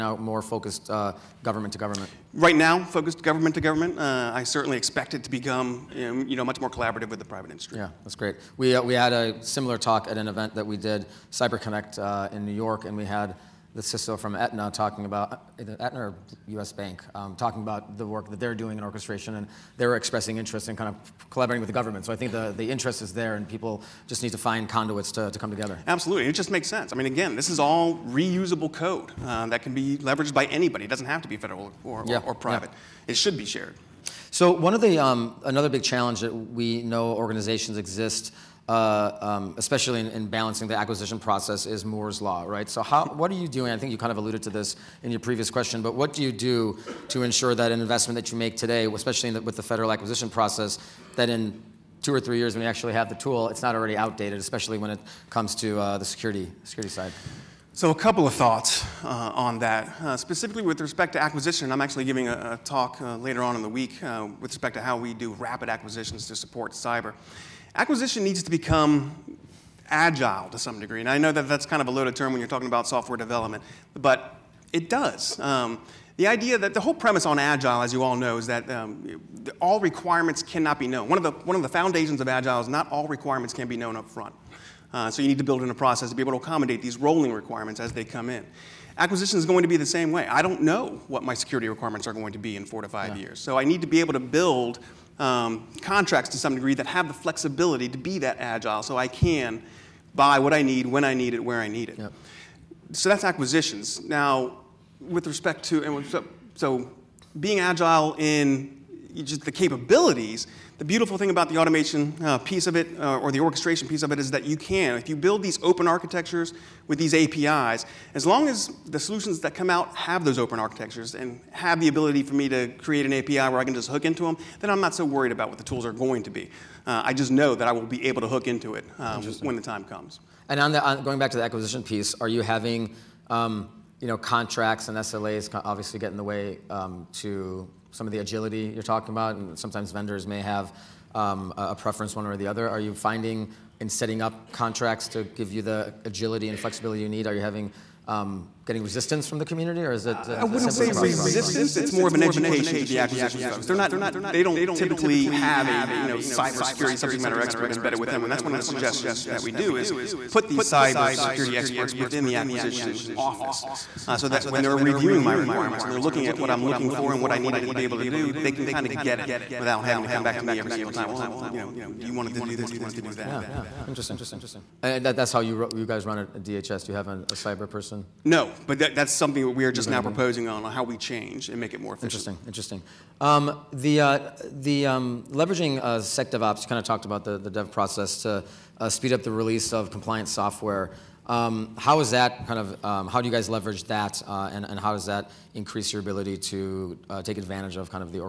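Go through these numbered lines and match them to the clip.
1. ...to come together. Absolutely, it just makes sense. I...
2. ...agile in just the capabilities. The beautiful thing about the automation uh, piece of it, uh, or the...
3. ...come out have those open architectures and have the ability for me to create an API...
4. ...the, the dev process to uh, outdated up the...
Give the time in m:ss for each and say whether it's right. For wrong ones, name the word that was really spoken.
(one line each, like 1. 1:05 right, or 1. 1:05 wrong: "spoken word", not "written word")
1. 0:25 right
2. 1:47 right
3. 1:59 right
4. 3:07 wrong: "speed", not "outdated".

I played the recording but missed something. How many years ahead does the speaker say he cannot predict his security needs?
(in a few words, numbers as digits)
4 to 5 years.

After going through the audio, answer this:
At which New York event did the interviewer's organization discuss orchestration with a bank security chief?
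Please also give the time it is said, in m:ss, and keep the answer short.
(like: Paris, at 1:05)
CyberConnect, at 0:11.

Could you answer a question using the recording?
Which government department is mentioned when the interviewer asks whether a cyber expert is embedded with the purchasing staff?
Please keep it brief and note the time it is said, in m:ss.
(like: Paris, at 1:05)
DHS, at 2:56.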